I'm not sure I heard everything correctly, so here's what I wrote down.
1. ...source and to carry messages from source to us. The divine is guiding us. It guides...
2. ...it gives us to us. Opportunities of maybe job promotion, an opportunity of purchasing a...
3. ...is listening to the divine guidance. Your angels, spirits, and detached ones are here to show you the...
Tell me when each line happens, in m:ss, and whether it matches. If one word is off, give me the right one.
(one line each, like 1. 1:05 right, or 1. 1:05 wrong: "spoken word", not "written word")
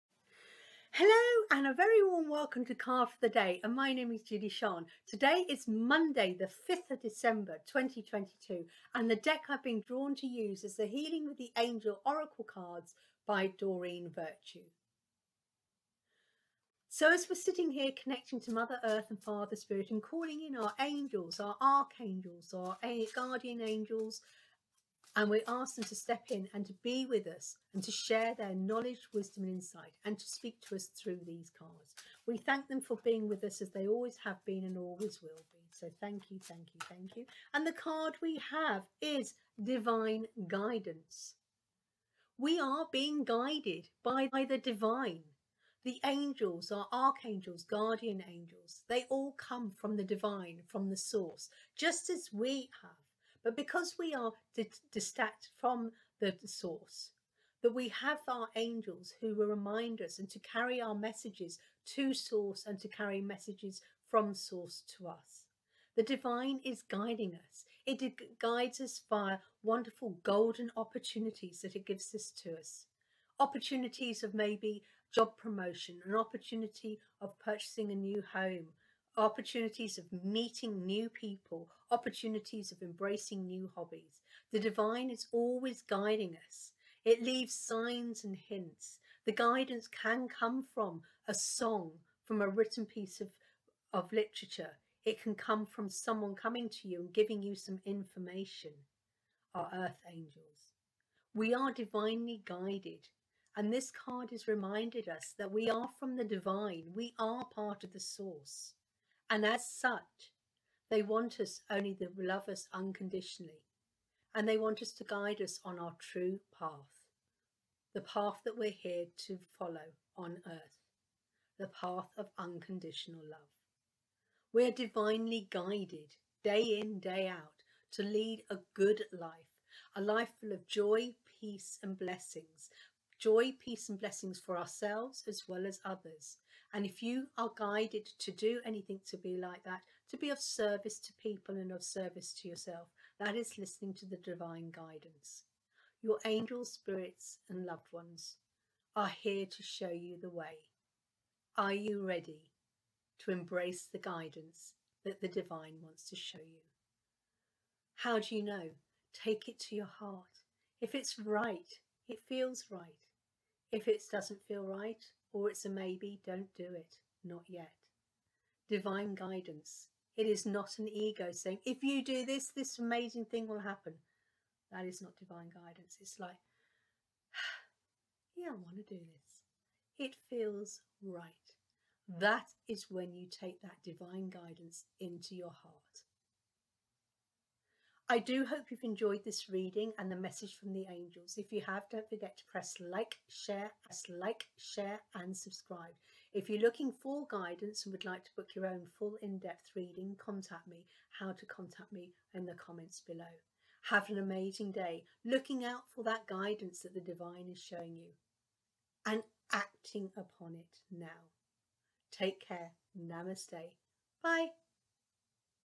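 1. 1:02 right
2. 1:11 right
3. 2:23 wrong: "loved", not "detached".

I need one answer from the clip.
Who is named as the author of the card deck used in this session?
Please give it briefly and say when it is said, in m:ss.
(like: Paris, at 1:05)
Doreen Virtue, at 0:13.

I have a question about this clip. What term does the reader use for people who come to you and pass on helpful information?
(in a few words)
Earth angels.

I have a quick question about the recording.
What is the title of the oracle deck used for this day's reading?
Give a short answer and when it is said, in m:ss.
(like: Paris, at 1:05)
Healing with the Angel Oracle cards, at 0:10.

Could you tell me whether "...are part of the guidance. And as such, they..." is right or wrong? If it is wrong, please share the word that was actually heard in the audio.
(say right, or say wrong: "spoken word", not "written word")
wrong: "source", not "guidance".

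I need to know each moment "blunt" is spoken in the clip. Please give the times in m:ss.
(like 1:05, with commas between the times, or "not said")
not said.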